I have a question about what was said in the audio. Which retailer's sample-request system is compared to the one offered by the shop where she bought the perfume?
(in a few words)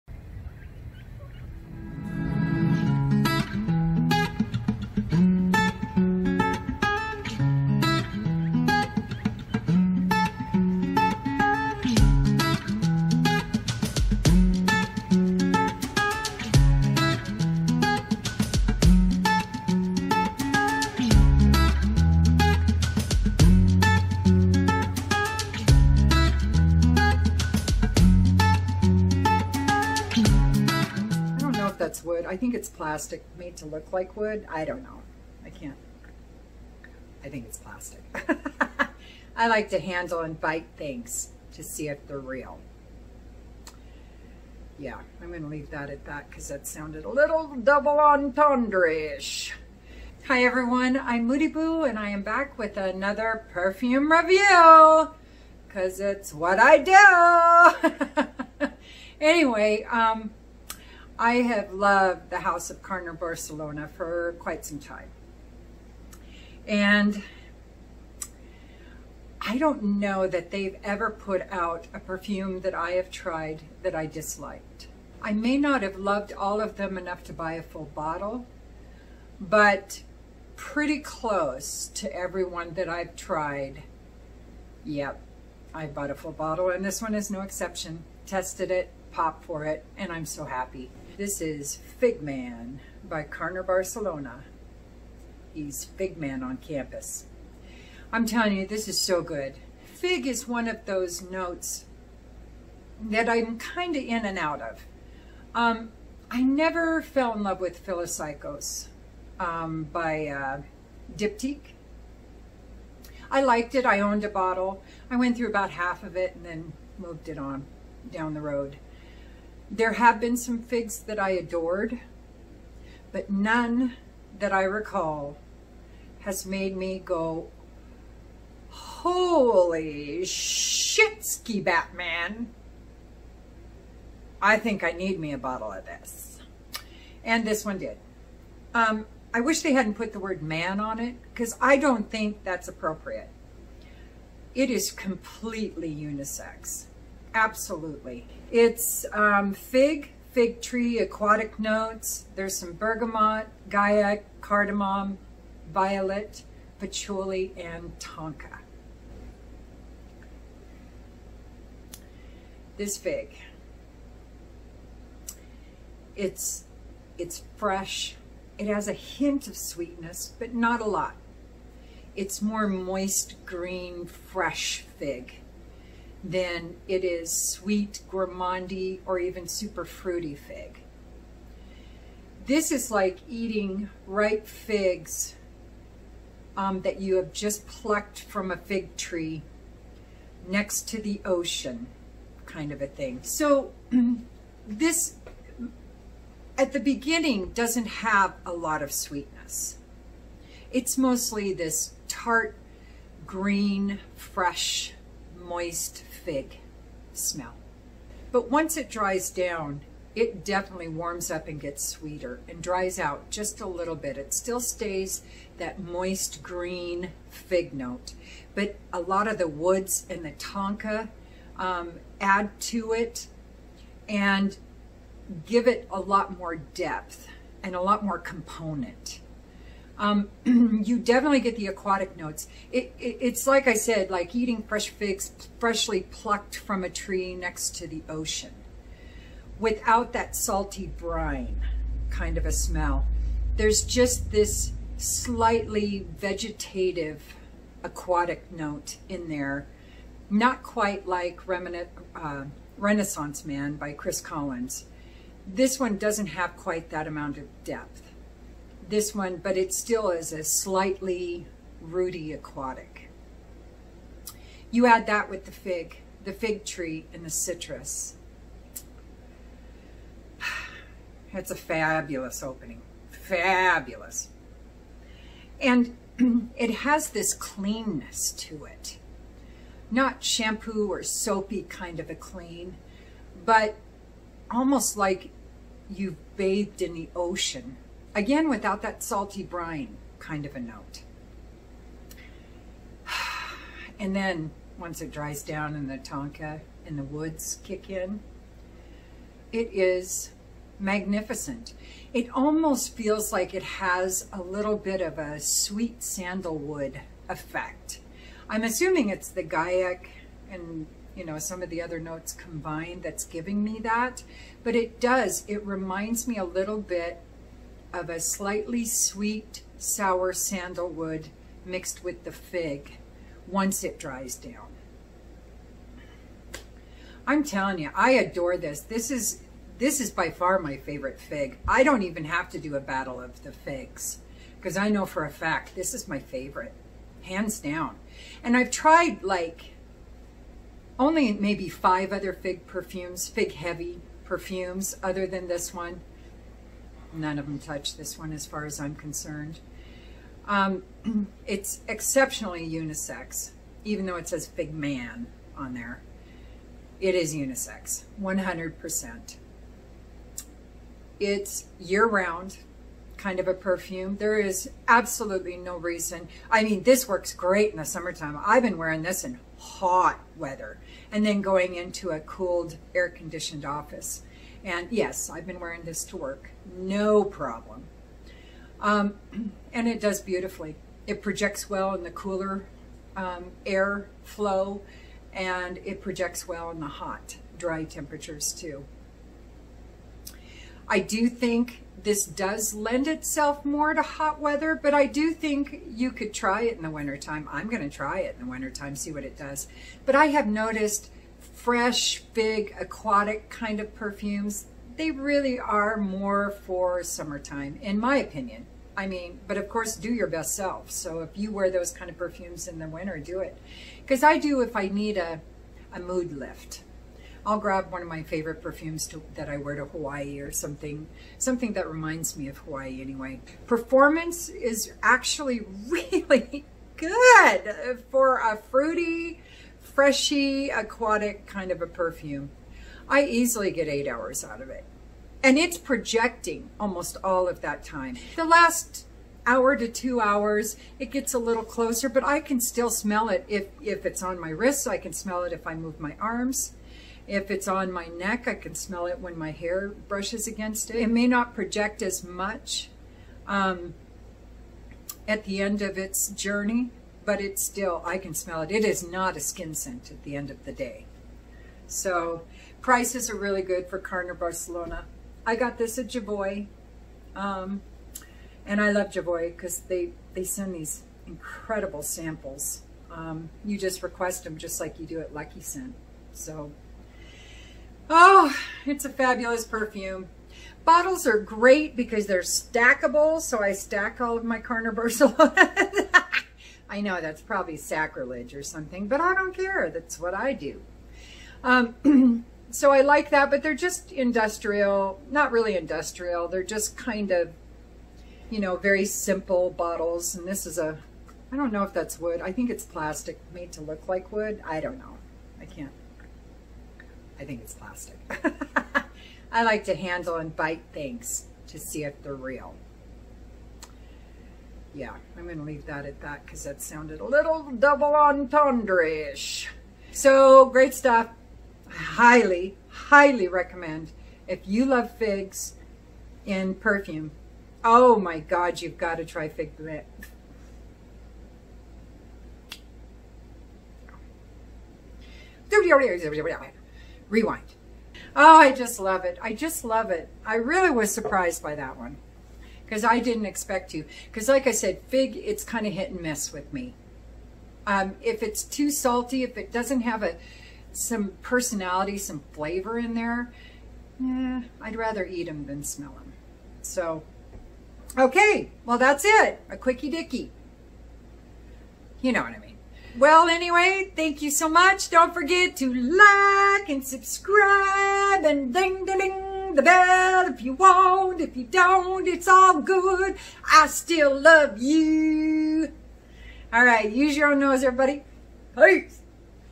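Lucky Scent.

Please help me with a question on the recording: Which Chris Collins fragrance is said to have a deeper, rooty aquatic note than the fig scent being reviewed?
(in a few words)
Renaissance Man.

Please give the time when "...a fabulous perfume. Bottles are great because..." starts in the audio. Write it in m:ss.
7:59.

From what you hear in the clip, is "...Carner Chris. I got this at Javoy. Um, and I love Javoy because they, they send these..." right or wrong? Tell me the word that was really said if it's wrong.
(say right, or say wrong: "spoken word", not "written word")
wrong: "Barcelona", not "Chris".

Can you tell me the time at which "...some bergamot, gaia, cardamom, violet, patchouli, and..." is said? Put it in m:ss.
2:32.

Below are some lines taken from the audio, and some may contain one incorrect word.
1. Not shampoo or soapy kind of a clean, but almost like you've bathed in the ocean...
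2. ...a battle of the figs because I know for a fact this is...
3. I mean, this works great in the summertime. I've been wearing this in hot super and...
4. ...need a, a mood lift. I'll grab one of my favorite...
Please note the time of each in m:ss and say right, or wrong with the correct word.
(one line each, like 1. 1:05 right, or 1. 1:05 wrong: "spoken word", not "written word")
1. 4:39 right
2. 5:32 right
3. 6:06 wrong: "weather", not "super"
4. 6:54 right.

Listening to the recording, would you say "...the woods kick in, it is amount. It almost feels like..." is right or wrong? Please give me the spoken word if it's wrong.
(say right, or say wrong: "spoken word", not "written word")
wrong: "magnificent", not "amount".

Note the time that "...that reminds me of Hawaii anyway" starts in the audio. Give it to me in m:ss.
7:01.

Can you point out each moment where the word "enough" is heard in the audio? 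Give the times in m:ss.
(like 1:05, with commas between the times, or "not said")
1:16.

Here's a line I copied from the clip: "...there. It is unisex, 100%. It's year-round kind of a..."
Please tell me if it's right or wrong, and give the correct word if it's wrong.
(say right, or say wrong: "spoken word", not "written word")
right.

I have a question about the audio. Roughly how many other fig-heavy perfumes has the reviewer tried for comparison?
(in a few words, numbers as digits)
5.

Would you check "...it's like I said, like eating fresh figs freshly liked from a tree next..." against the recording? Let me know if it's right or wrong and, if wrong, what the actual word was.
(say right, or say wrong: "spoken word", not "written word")
wrong: "plucked", not "liked".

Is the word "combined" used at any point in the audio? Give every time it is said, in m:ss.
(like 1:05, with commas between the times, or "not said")
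5:12.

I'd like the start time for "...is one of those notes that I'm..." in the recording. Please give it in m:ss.
1:40.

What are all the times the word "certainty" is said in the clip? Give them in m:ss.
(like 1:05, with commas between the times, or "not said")
not said.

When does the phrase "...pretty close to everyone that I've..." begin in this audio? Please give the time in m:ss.
1:20.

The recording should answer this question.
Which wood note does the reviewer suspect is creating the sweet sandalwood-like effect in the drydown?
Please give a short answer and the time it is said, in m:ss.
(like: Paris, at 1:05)
Guaiac, at 5:09.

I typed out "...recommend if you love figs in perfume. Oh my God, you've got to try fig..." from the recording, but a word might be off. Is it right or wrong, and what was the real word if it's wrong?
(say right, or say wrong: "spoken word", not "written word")
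right.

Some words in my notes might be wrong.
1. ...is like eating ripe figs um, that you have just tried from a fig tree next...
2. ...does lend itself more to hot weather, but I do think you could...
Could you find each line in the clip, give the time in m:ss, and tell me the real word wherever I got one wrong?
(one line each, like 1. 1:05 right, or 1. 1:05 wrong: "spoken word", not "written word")
1. 3:02 wrong: "plucked", not "tried"
2. 6:32 right.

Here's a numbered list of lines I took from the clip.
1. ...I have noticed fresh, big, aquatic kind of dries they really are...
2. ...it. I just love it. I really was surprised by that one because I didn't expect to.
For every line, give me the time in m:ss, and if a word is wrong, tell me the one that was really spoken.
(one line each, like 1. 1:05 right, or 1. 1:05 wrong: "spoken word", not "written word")
1. 6:40 wrong: "perfumes", not "dries"
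2. 8:59 right.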